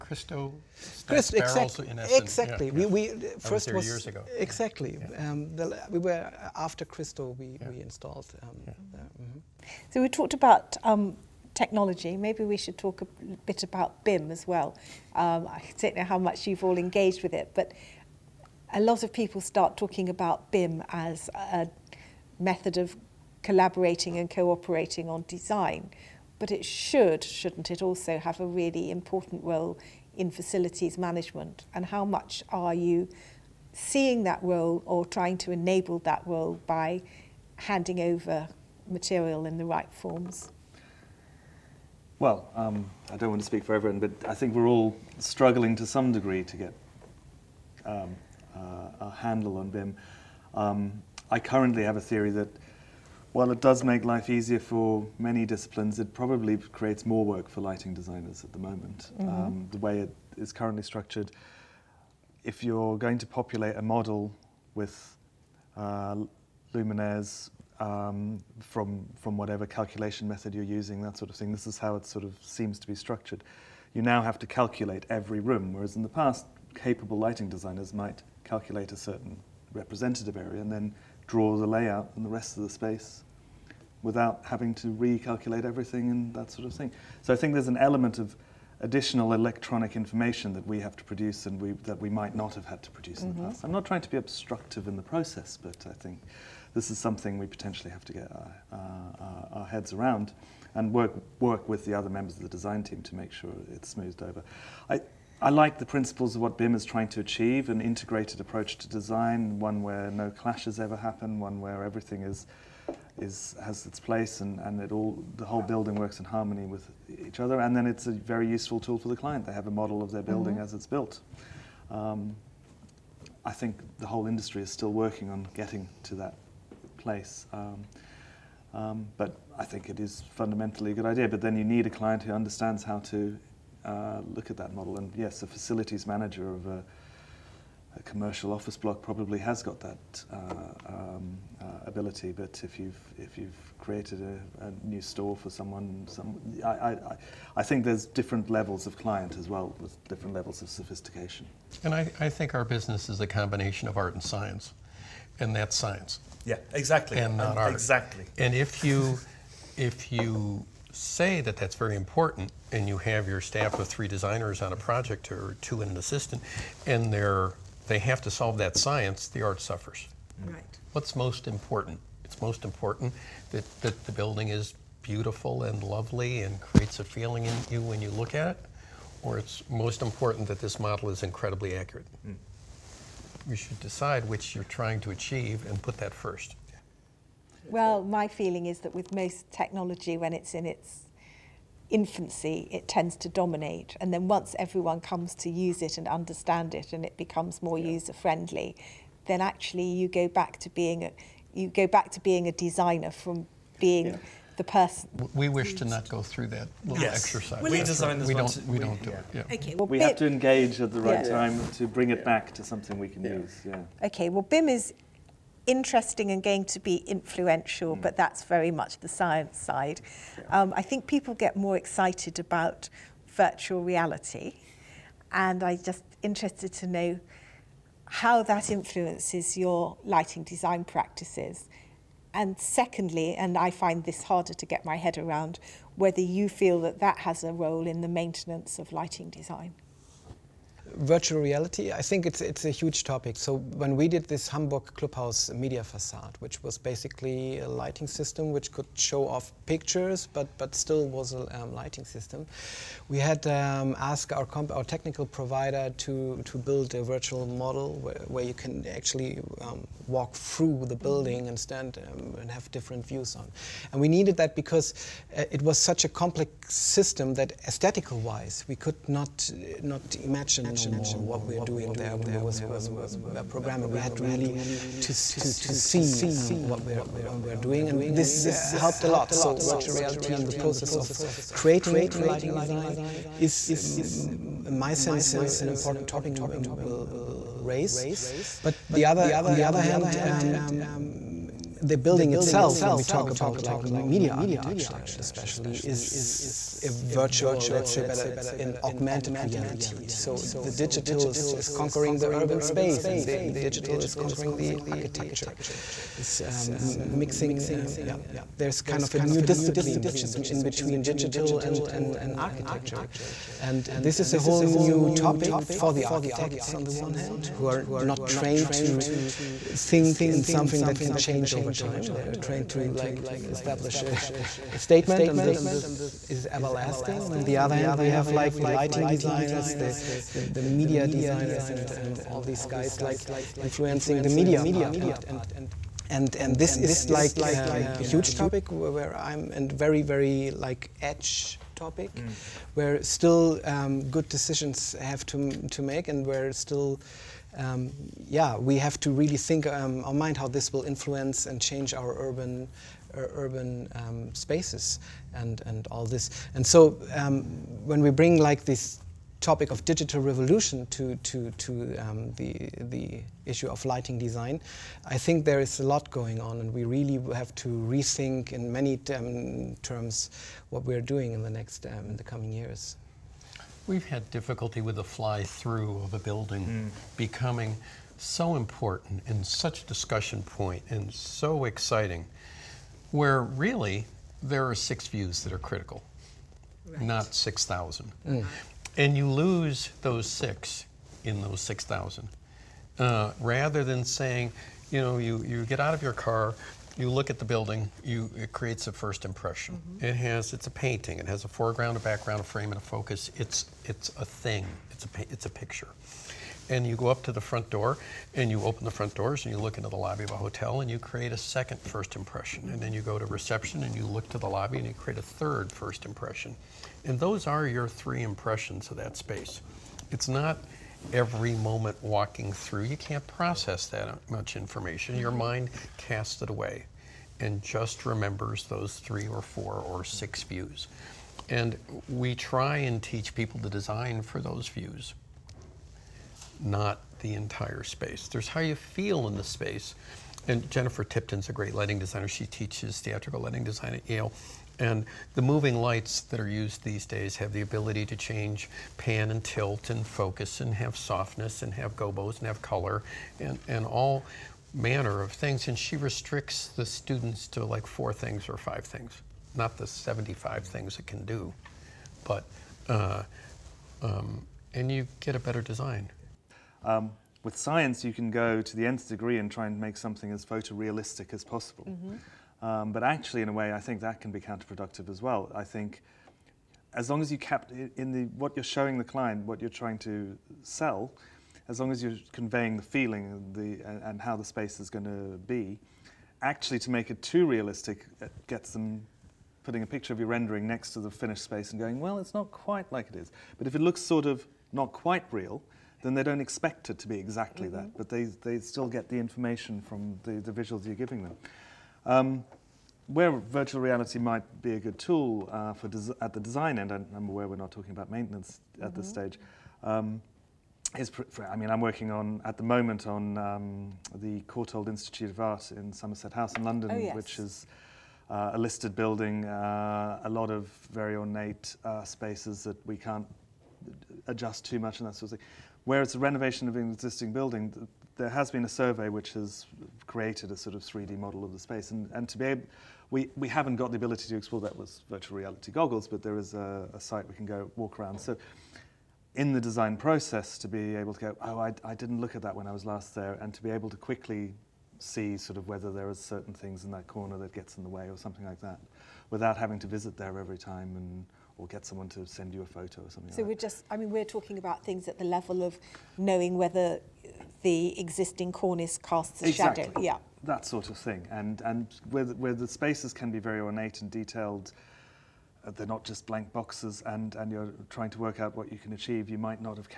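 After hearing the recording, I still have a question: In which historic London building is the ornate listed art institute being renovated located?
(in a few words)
Somerset House.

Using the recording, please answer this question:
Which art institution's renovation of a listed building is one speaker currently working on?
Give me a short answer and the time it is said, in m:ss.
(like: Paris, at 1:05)
Courtauld Institute of Art, at 8:34.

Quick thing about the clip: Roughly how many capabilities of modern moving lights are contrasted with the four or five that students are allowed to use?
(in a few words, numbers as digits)
75.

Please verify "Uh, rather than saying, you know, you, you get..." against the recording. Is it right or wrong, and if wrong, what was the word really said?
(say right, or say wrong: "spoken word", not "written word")
right.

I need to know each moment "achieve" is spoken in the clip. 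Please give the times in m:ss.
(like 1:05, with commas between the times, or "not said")
1:47, 3:05, 9:28.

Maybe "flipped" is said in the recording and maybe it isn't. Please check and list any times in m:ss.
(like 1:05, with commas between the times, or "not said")
not said.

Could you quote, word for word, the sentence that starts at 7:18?
There's how you feel in the space.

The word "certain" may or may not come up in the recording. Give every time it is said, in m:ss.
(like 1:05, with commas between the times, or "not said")
1:18, 9:06.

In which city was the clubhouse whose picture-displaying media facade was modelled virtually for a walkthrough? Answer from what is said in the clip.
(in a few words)
Hamburg.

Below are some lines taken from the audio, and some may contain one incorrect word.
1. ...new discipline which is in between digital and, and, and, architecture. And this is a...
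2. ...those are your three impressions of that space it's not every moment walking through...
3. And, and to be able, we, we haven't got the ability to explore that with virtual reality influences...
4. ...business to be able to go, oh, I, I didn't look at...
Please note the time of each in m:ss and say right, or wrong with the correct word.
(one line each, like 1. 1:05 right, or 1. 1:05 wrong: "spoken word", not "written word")
1. 5:09 right
2. 6:57 right
3. 8:51 wrong: "goggles", not "influences"
4. 8:59 wrong: "process", not "business".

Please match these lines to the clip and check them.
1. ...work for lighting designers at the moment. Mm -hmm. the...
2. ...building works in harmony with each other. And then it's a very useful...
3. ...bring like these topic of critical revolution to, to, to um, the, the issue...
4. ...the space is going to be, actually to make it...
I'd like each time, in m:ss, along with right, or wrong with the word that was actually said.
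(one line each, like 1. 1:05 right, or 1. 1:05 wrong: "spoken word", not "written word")
1. 0:57 right
2. 1:55 right
3. 5:58 wrong: "digital", not "critical"
4. 8:04 right.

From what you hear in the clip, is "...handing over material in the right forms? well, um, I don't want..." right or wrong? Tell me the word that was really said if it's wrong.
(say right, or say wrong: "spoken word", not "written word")
right.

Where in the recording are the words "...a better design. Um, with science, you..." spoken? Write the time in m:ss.
7:45.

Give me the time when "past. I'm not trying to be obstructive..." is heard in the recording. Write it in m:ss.
1:33.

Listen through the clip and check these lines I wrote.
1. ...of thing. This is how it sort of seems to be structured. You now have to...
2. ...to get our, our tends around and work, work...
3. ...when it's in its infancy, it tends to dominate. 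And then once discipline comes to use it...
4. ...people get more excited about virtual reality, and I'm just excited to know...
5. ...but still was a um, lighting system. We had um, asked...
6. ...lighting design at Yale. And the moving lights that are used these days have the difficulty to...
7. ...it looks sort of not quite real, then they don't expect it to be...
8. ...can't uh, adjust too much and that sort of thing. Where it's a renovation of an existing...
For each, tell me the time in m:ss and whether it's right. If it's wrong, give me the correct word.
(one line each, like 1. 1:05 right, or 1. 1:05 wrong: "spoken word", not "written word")
1. 1:11 right
2. 1:38 wrong: "heads", not "tends"
3. 3:10 wrong: "everyone", not "discipline"
4. 3:41 wrong: "interested", not "excited"
5. 4:10 right
6. 7:23 wrong: "ability", not "difficulty"
7. 8:13 right
8. 8:42 right.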